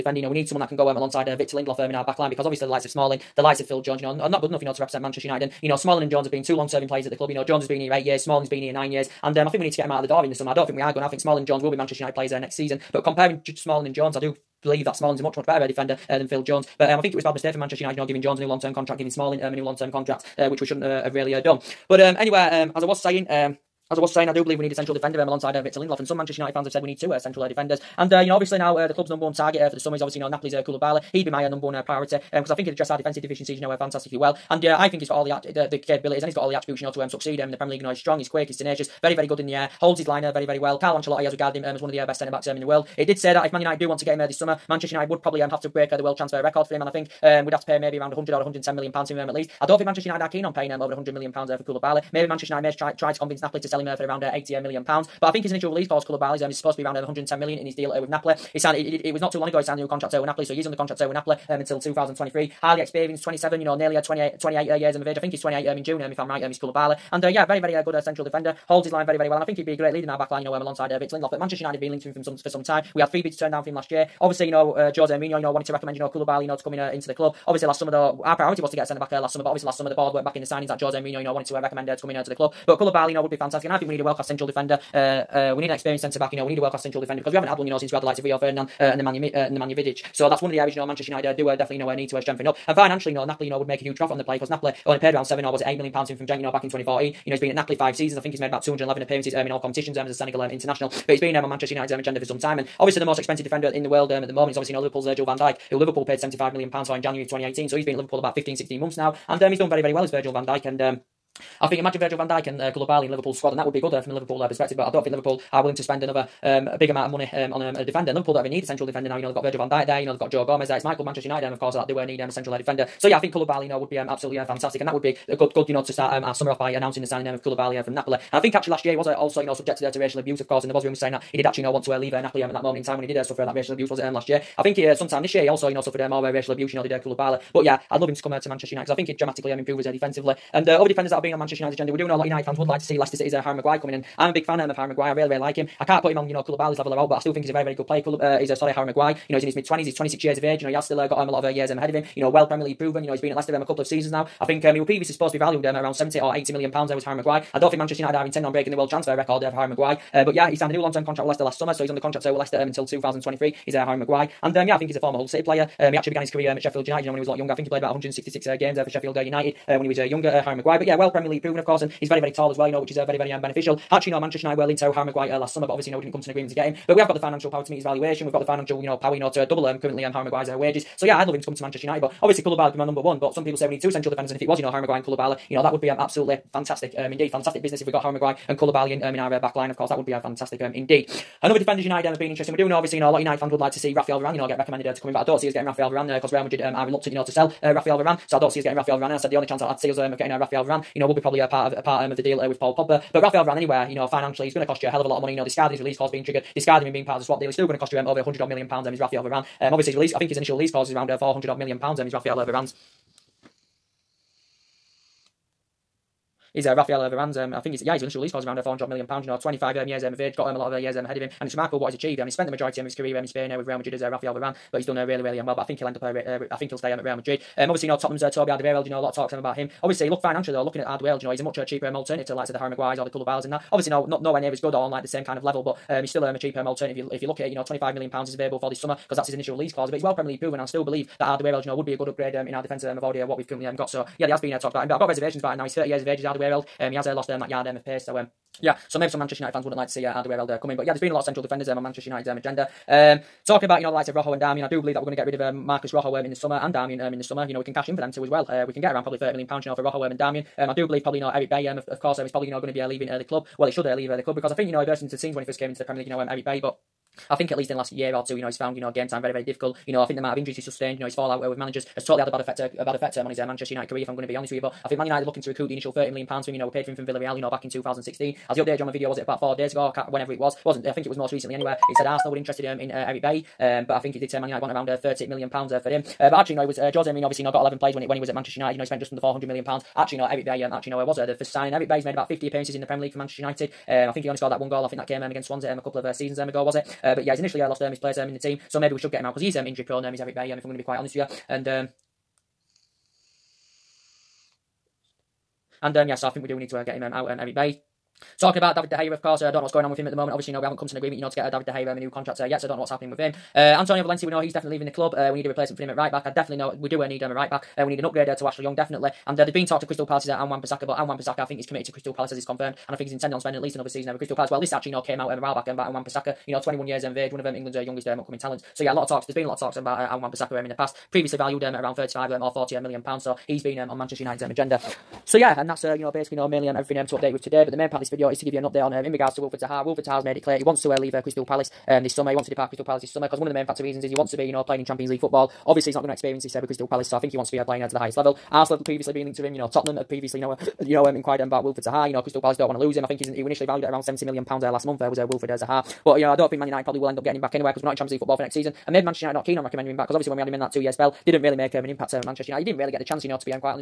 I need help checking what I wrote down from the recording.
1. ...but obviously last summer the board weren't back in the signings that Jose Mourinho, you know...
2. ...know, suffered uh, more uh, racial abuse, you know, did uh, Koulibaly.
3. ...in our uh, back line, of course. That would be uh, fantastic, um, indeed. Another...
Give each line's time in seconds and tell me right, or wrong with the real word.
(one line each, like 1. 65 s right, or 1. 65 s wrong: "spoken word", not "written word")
1. 79 s right
2. 135 s right
3. 189 s right.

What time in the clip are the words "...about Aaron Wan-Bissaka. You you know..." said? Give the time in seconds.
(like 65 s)
325 s.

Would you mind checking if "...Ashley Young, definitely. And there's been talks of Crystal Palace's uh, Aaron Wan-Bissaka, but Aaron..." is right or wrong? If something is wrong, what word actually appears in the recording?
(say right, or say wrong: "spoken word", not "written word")
right.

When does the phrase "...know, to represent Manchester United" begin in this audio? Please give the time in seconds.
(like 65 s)
4 s.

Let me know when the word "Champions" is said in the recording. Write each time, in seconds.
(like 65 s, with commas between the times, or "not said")
344 s, 357 s.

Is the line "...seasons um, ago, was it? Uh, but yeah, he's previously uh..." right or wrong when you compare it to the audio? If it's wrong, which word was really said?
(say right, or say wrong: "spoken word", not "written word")
wrong: "initially", not "previously".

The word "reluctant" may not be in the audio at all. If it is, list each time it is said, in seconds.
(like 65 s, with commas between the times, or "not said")
196 s.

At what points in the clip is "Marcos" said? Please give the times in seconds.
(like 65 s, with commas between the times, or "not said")
255 s.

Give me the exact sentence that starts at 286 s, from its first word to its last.
Uh, but actually, you know, it was uh, Jose Mourinho.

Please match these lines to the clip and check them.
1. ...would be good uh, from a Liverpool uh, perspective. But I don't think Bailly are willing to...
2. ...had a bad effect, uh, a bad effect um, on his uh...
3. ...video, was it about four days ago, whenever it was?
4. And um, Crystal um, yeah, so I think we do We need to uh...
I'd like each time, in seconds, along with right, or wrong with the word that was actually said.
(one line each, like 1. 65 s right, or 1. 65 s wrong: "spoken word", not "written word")
1. 113 s wrong: "Liverpool", not "Bailly"
2. 272 s right
3. 278 s right
4. 301 s wrong: "And", not "Crystal".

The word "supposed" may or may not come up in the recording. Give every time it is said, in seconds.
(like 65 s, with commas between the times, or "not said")
56 s, 155 s.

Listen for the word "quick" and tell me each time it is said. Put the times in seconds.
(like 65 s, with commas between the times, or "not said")
38 s.